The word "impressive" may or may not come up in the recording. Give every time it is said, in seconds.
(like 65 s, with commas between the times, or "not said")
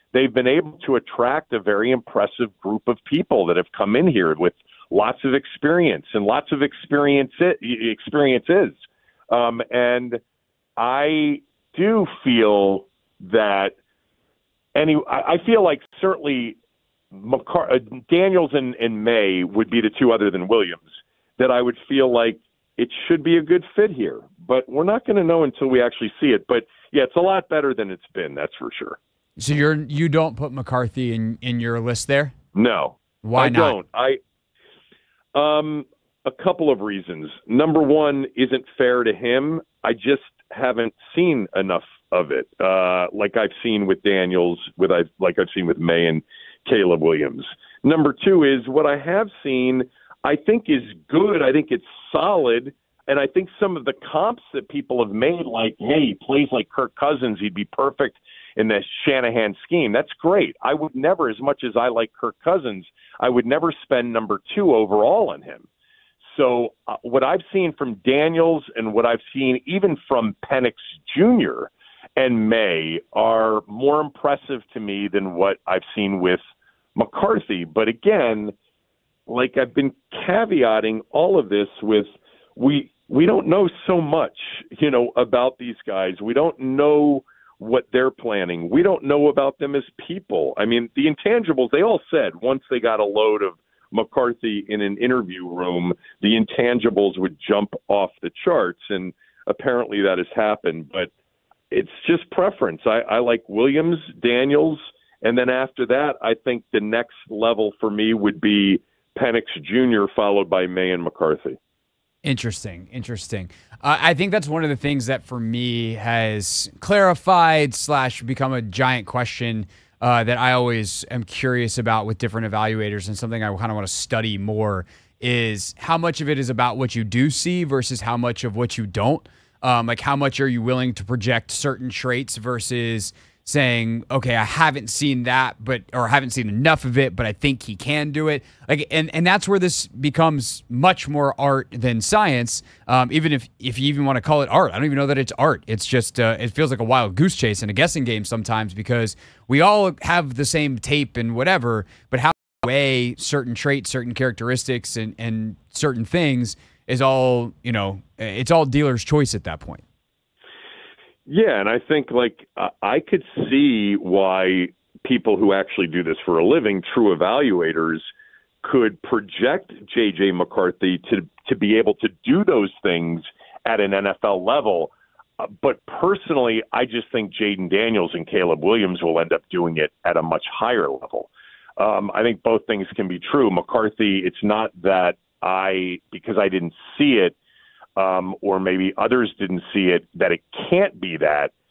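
1 s, 74 s.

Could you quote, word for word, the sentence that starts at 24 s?
But we're not going to know until we actually see it.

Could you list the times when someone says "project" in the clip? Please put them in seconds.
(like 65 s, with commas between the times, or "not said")
131 s, 169 s.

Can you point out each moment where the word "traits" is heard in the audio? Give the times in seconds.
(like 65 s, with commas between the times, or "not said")
131 s, 153 s.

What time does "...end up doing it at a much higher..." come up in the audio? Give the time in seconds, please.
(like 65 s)
179 s.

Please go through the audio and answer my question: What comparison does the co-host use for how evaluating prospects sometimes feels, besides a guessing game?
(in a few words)
A wild goose chase.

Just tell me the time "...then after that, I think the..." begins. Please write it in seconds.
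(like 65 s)
105 s.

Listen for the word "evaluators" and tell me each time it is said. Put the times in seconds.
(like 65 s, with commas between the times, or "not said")
122 s, 167 s.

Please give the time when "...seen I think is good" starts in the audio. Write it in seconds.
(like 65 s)
49 s.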